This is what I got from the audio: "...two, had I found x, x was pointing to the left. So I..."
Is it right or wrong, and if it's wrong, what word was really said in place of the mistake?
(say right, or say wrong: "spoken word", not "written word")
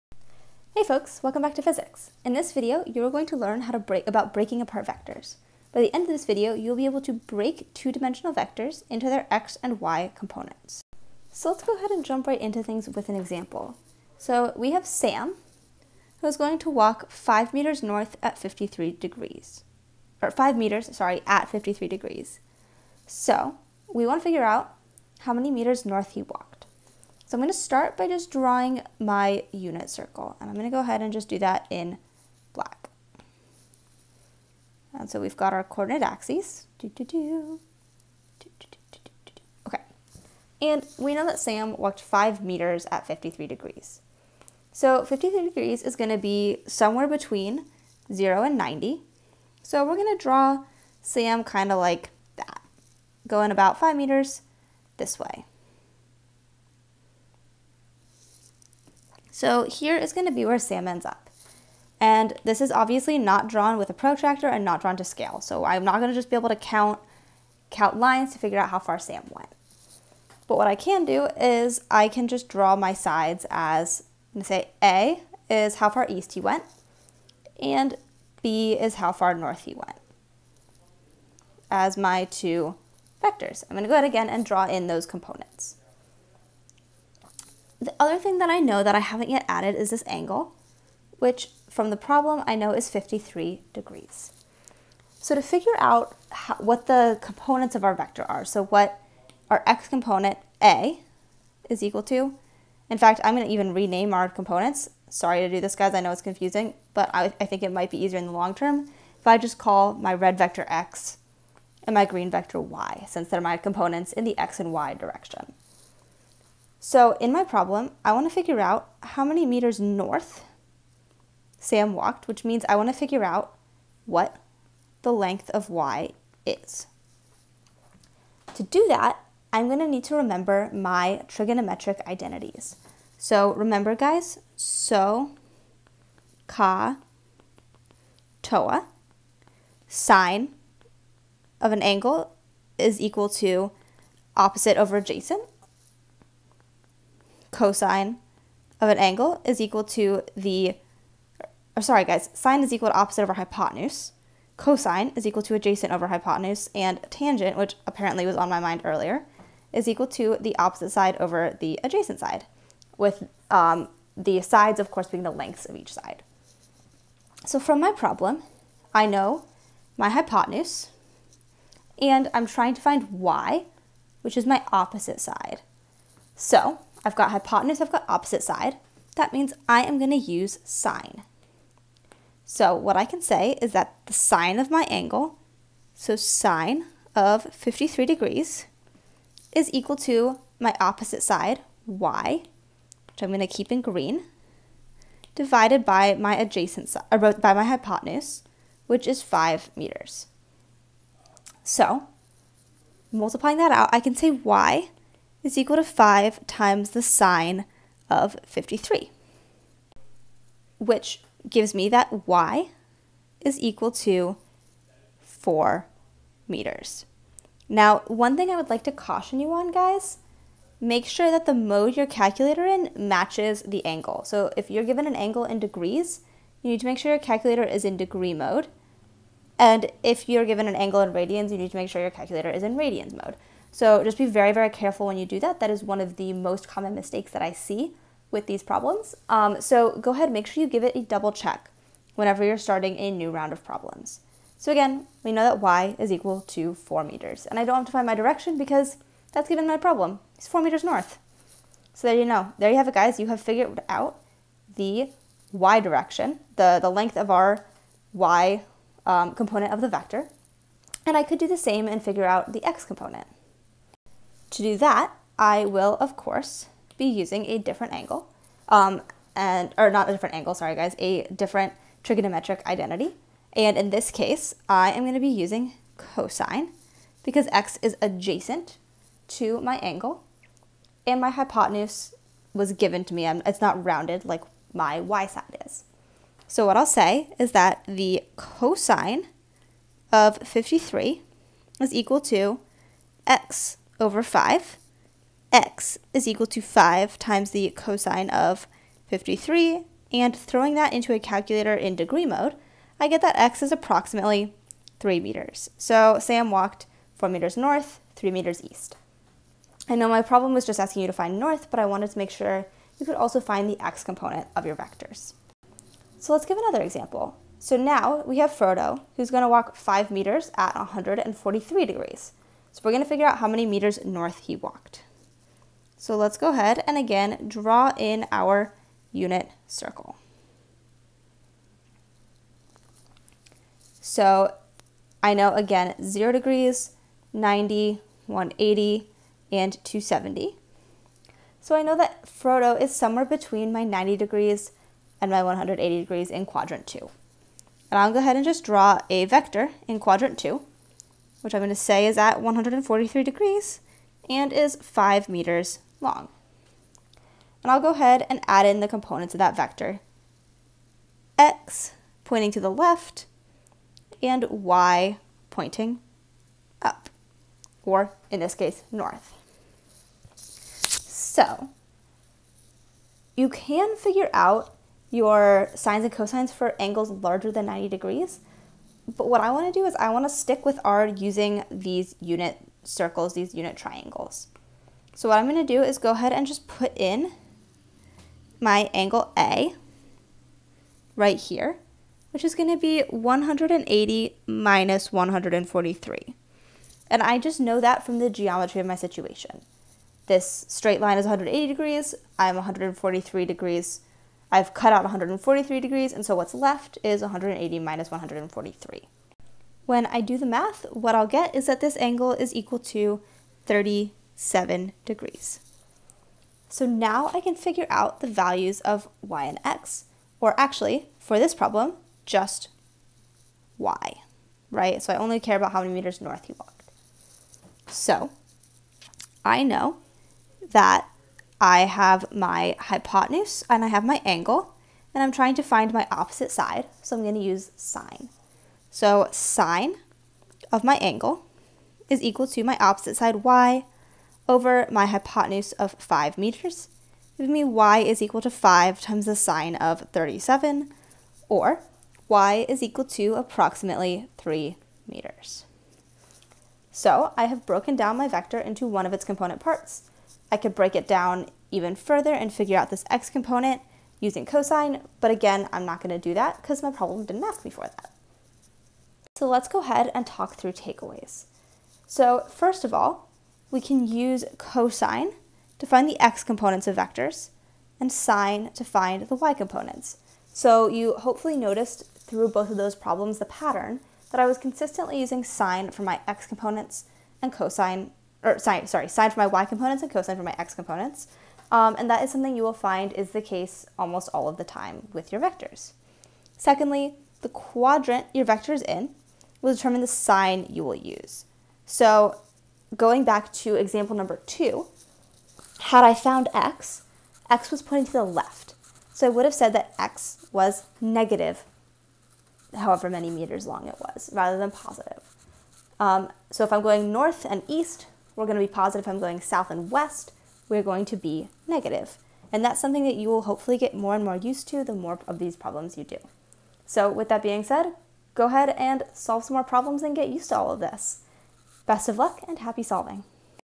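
right.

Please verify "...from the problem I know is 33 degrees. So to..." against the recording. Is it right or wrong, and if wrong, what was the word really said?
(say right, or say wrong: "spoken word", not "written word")
wrong: "53", not "33".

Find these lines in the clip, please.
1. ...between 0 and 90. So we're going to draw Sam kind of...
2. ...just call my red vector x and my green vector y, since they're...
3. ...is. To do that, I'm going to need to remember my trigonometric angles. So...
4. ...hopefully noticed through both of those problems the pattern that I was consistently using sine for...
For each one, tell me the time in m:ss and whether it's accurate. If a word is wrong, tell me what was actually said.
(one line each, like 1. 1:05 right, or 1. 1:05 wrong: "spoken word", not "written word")
1. 0:47 right
2. 1:49 right
3. 2:06 wrong: "identities", not "angles"
4. 8:01 right.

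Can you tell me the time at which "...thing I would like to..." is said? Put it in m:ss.
3:38.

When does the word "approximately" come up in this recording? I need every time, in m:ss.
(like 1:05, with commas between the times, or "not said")
5:03, 7:33.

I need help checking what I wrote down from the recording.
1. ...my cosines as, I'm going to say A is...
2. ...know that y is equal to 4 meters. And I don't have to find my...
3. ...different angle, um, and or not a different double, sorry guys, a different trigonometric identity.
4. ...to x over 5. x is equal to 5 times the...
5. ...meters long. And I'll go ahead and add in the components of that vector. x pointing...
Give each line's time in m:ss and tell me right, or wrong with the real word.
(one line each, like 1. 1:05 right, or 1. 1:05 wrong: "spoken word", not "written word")
1. 1:12 wrong: "sides", not "cosines"
2. 4:05 right
3. 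4:27 wrong: "angle", not "double"
4. 4:52 right
5. 5:55 right.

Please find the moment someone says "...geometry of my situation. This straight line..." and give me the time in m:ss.
6:38.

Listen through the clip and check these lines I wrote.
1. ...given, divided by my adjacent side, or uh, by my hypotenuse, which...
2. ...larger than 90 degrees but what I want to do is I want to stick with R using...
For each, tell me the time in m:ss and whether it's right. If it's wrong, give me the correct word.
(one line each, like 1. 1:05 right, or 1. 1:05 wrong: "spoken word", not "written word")
1. 3:13 wrong: "green", not "given"
2. 6:17 right.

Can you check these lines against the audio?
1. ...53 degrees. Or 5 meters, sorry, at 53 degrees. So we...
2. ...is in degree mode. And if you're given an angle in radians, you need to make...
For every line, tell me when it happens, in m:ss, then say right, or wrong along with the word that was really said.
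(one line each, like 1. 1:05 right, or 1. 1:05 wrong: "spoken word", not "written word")
1. 0:18 right
2. 3:47 right.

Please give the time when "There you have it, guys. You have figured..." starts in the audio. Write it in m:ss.
4:12.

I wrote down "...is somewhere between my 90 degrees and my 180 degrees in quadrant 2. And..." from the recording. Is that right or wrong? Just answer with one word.
right.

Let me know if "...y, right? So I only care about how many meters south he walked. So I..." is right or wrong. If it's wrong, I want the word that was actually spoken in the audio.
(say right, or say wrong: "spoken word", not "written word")
wrong: "north", not "south".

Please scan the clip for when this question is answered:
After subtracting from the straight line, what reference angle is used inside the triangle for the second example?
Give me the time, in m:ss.
6:53.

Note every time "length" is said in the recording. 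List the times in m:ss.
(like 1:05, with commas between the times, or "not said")
2:05, 2:45, 4:16.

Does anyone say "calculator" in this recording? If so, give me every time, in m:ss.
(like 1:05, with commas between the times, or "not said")
3:42, 3:47, 3:52, 5:01.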